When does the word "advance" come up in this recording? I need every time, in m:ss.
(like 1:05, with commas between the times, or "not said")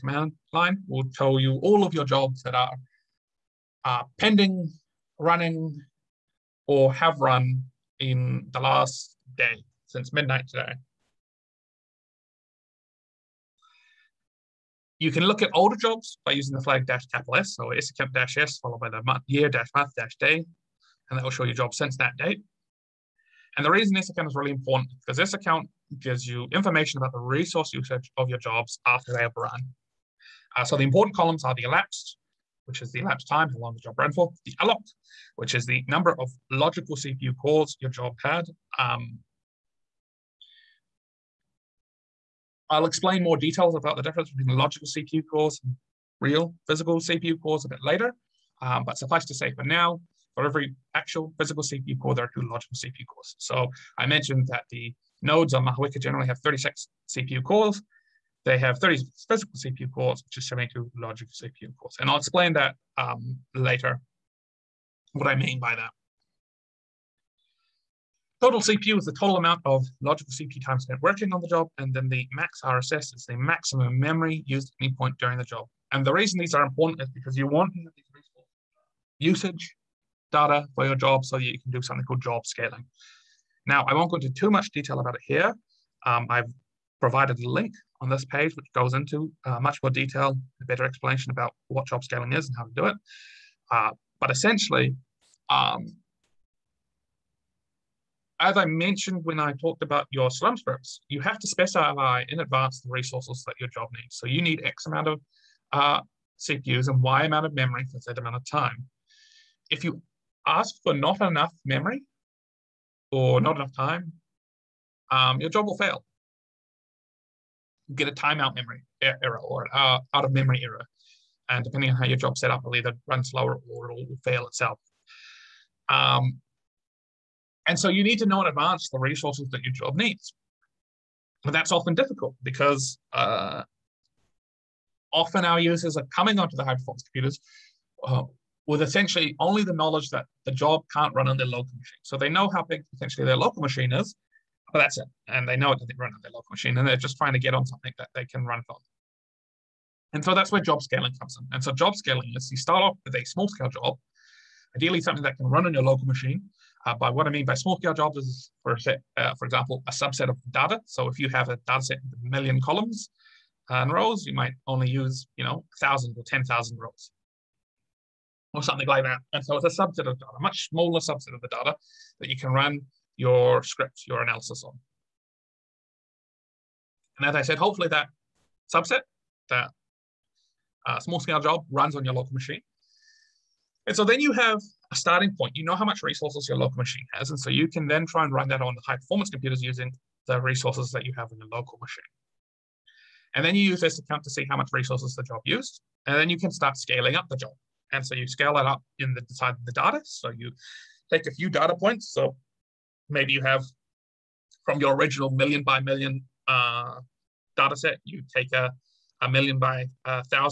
1:42, 2:08.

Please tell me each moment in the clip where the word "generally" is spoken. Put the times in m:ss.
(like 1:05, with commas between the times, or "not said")
0:56.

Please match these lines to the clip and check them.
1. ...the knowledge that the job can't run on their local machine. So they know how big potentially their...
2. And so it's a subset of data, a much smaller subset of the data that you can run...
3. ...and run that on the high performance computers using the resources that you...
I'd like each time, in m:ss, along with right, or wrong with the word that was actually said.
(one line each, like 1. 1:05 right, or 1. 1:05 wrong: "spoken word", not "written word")
1. 2:19 right
2. 2:49 right
3. 3:08 right.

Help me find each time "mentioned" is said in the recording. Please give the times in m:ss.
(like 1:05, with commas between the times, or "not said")
0:54, 1:38.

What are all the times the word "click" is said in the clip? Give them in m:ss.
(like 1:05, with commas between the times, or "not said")
not said.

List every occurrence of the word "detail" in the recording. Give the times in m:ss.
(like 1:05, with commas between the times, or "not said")
0:43, 1:24, 1:29.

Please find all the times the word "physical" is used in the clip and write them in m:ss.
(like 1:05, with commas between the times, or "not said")
0:46, 0:51, 0:59.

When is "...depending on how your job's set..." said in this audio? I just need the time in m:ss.
2:01.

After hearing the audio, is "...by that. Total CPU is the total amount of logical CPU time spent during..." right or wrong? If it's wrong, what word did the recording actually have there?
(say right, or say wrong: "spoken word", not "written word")
wrong: "working", not "during".